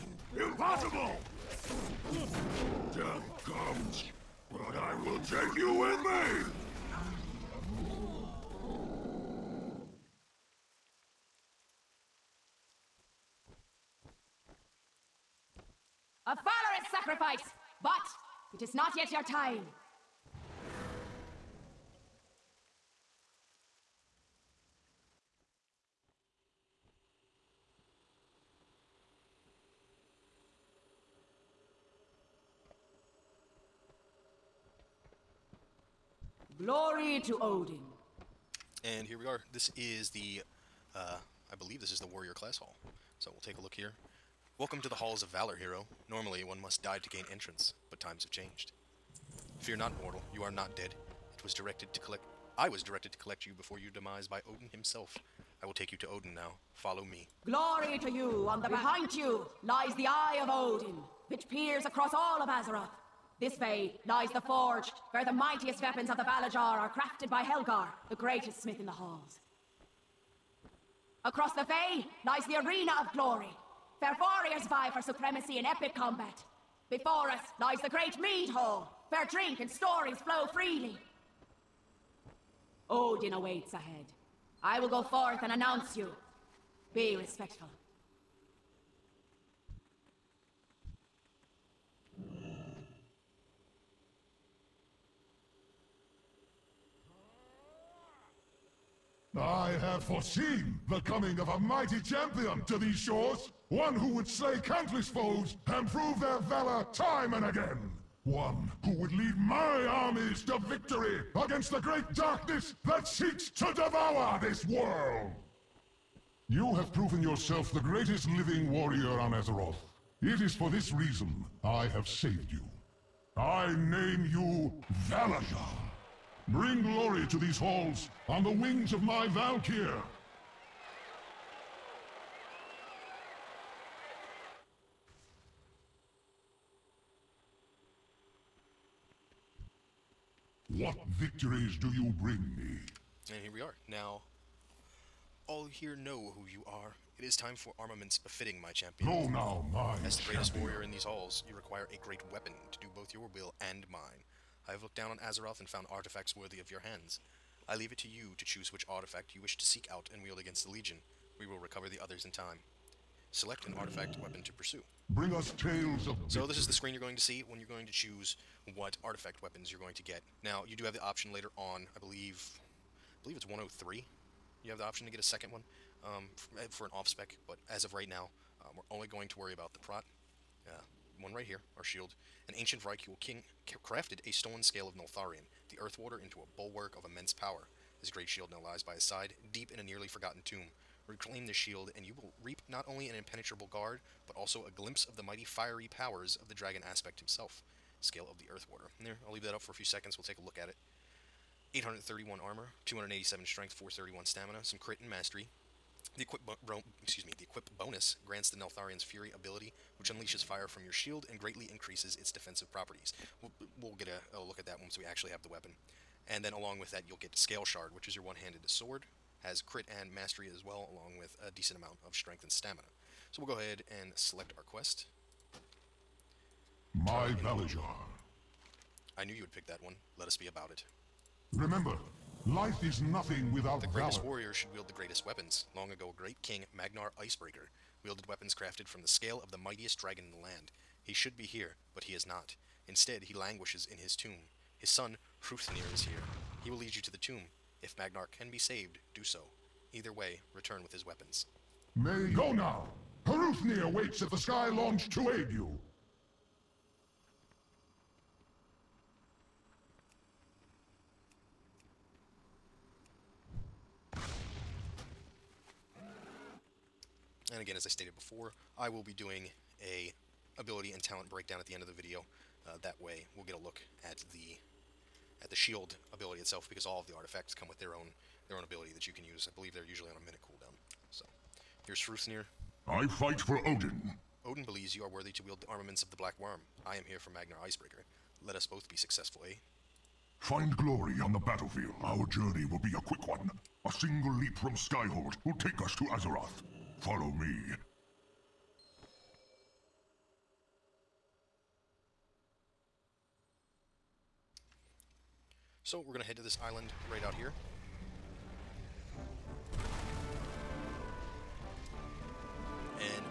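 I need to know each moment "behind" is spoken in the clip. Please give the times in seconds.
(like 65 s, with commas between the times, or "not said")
58 s.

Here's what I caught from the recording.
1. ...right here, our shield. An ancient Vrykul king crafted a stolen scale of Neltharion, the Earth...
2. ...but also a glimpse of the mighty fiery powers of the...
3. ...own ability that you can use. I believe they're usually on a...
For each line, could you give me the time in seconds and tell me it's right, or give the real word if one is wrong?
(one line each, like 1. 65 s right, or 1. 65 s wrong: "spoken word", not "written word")
1. 181 s right
2. 194 s right
3. 278 s right.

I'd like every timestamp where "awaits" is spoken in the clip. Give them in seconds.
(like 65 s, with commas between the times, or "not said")
83 s, 253 s.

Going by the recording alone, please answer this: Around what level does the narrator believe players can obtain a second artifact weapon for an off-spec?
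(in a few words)
103.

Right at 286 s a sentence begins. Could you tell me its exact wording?
I am here for Magnar Icebreaker.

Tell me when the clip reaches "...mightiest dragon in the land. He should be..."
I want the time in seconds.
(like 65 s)
239 s.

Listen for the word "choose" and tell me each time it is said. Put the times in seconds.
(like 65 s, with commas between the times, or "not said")
158 s, 167 s.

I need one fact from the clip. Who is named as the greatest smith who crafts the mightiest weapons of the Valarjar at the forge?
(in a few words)
Helgar.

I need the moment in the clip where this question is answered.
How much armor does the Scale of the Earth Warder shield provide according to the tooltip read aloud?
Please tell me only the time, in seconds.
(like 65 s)
201 s.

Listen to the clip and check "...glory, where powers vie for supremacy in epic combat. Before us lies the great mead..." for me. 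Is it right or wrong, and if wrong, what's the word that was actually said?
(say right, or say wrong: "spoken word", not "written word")
wrong: "warriors", not "powers".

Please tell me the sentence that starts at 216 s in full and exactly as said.
And then along with that, you'll get Scale Shard, which is your one-handed sword.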